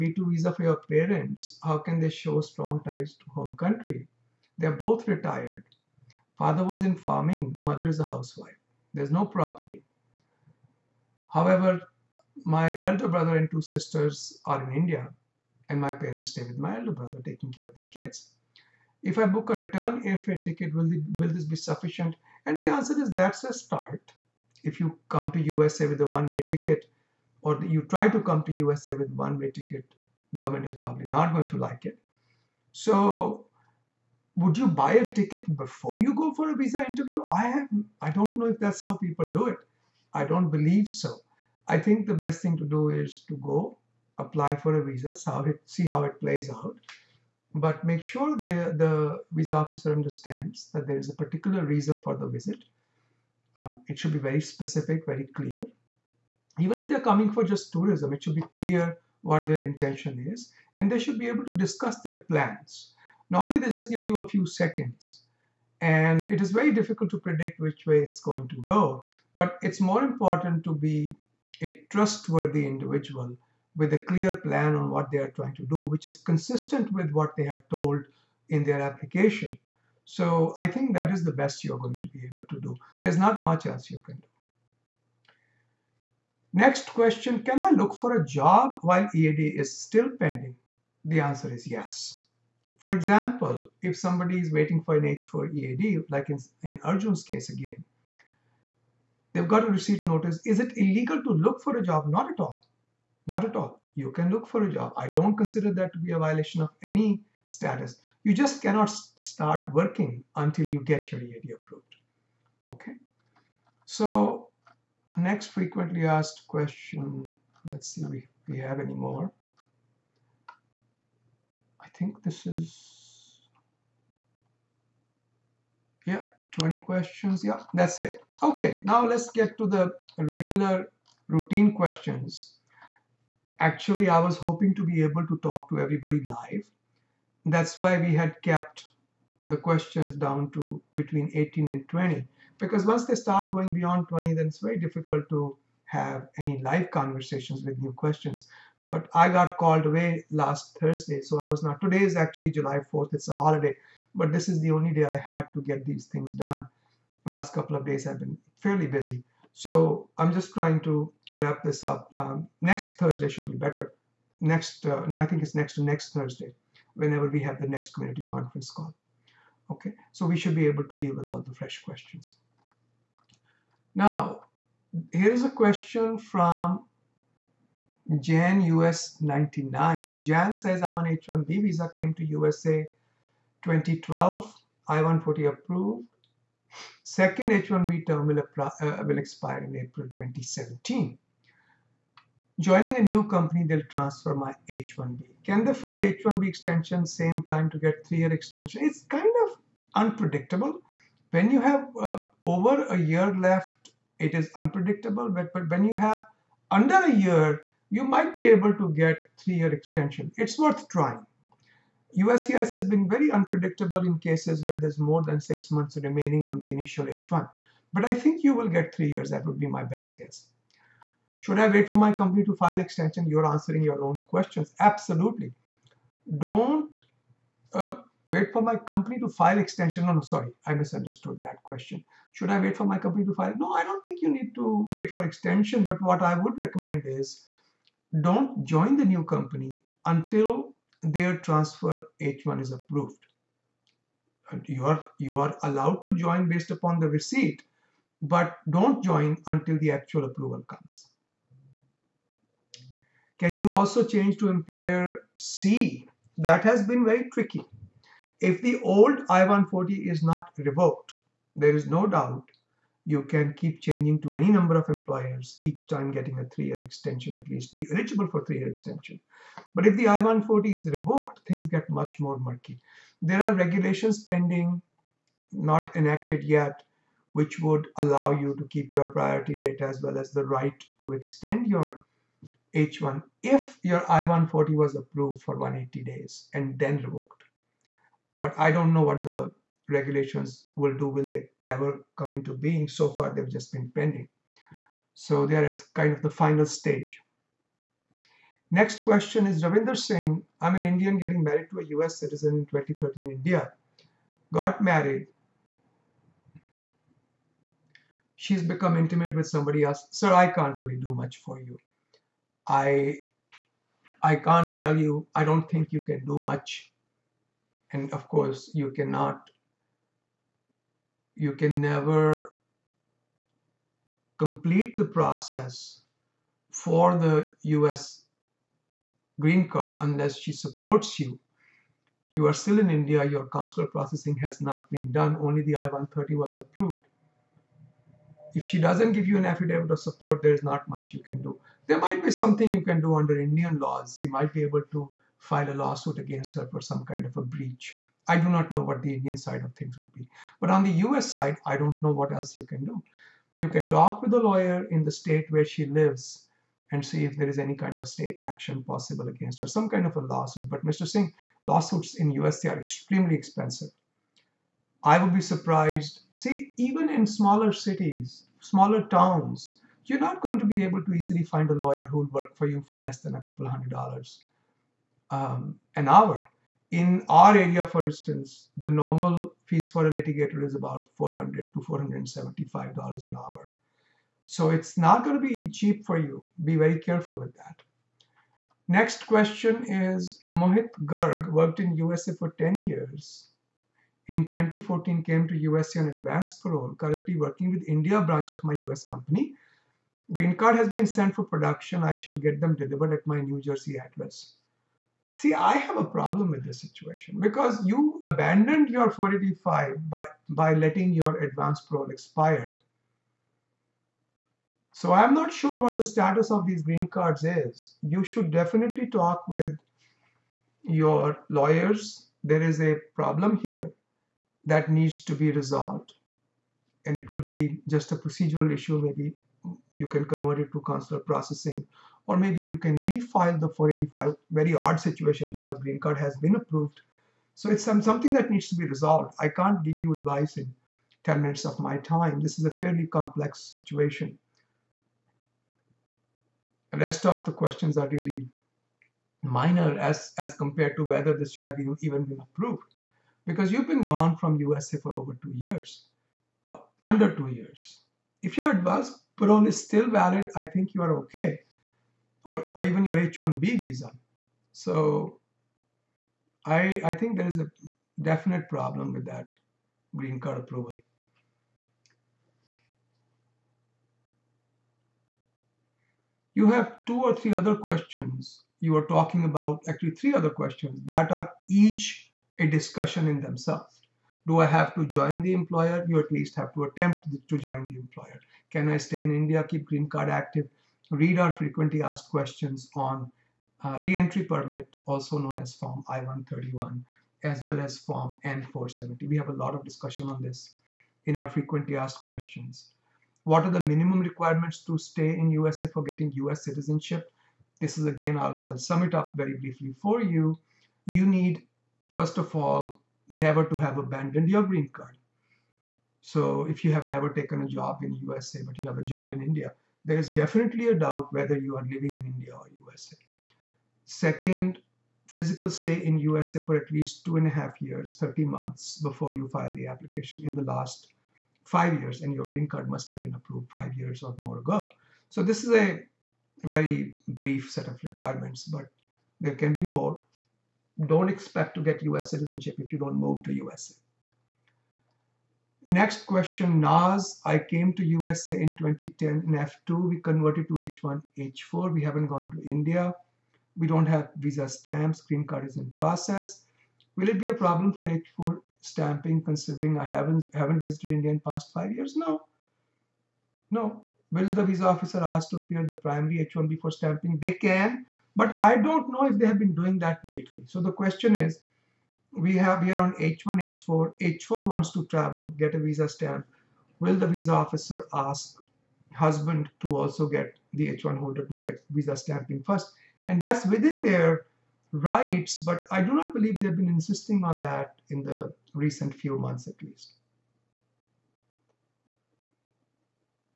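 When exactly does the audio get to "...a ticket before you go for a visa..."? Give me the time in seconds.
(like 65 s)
34 s.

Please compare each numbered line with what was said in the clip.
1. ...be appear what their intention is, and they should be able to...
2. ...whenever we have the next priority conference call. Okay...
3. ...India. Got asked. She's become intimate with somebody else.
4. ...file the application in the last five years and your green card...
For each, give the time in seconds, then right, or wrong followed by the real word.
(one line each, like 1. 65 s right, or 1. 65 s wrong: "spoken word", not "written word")
1. 58 s wrong: "clear", not "appear"
2. 166 s wrong: "community", not "priority"
3. 303 s wrong: "married", not "asked"
4. 529 s right.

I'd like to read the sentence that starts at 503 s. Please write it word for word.
What are the minimum requirements to stay in USA for getting US citizenship?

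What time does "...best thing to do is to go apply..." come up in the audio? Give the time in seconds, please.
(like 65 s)
42 s.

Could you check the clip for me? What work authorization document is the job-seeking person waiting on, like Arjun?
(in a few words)
H4 EAD.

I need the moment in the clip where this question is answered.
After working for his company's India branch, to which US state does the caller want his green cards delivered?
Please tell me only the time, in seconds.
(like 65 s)
403 s.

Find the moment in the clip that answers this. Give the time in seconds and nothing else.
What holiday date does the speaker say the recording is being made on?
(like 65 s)
152 s.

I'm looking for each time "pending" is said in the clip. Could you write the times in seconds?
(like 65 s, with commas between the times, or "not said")
90 s, 274 s, 293 s.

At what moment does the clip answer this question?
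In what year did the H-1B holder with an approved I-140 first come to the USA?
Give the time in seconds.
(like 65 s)
183 s.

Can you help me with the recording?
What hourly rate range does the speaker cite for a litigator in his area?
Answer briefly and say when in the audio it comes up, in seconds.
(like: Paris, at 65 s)
$400 to $475, at 381 s.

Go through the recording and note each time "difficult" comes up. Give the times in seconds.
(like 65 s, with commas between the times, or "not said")
66 s, 144 s.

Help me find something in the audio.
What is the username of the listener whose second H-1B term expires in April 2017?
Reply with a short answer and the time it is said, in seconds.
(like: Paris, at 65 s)
Jan US 99, at 178 s.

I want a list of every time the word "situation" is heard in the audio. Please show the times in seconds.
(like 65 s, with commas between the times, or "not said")
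406 s, 434 s, 443 s.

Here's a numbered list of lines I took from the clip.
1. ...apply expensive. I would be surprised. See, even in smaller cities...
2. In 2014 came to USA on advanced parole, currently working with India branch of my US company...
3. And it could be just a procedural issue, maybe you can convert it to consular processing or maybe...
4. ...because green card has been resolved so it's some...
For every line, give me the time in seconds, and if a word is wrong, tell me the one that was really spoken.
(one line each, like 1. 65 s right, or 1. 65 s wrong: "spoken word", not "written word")
1. 362 s wrong: "extremely", not "apply"
2. 394 s right
3. 427 s right
4. 435 s wrong: "approved", not "resolved".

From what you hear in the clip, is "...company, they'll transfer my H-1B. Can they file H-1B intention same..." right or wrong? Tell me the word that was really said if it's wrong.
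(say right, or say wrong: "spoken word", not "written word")
wrong: "extension", not "intention".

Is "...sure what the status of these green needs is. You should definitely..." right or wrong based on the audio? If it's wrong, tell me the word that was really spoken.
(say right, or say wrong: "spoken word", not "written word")
wrong: "cards", not "needs".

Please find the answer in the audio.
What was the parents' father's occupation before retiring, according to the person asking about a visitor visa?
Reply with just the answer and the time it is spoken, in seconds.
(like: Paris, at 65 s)
Farming, at 6 s.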